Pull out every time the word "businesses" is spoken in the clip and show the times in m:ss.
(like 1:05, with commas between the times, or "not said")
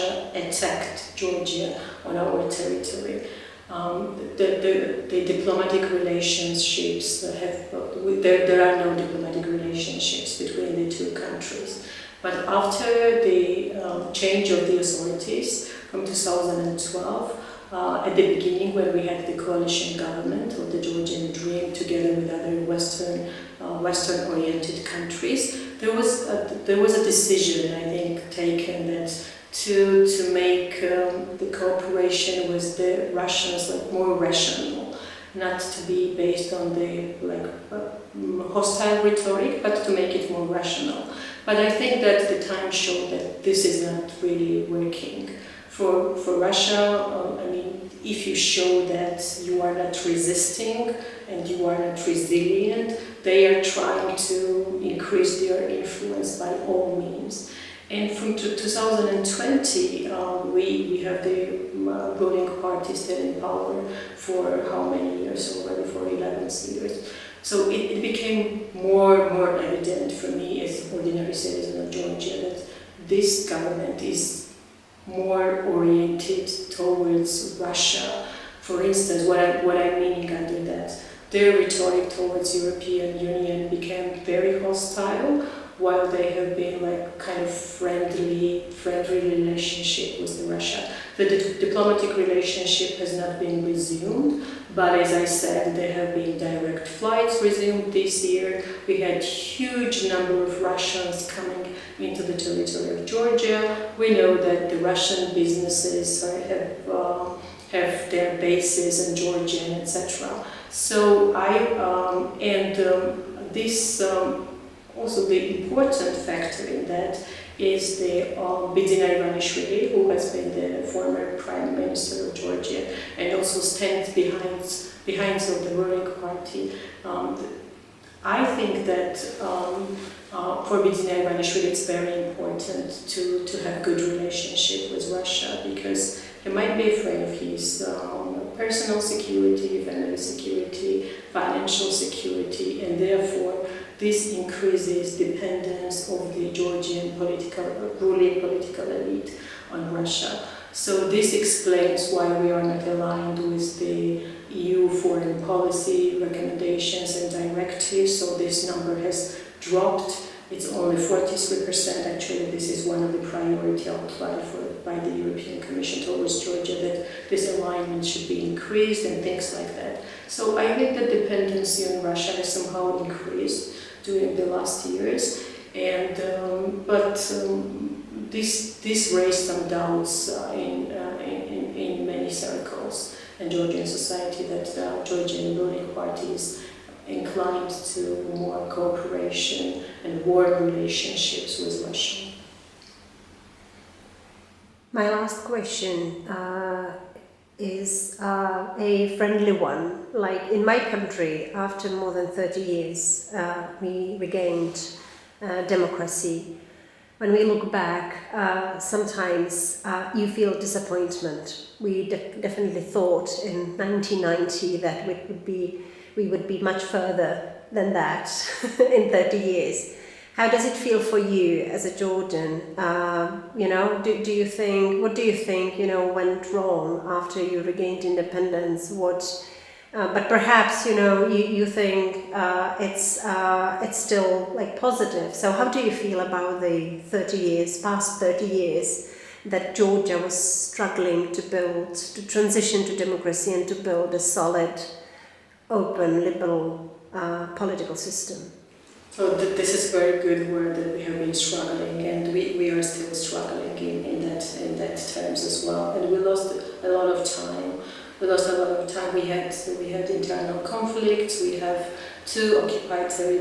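1:45.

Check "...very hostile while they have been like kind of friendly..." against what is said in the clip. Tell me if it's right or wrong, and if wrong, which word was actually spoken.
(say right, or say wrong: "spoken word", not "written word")
right.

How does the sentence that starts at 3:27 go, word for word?
When we look back, uh, sometimes uh, you feel disappointment.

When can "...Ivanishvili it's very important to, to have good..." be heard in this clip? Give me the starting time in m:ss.
2:11.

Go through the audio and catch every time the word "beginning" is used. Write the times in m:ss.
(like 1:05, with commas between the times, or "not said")
0:18.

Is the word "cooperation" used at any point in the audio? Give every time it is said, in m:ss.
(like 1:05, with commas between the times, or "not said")
0:31, 3:08.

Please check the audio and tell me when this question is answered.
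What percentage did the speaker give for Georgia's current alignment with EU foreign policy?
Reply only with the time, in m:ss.
2:40.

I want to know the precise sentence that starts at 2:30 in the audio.
So this explains why we are not aligned with the EU foreign policy recommendations and directives.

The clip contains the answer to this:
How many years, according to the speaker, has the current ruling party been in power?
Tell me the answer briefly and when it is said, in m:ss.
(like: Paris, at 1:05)
11, at 1:06.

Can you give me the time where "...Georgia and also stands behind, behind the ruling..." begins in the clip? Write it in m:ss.
2:02.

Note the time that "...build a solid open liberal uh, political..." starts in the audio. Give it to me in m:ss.
4:03.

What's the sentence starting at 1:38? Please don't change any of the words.
We had huge number of Russians coming into the territory of Georgia.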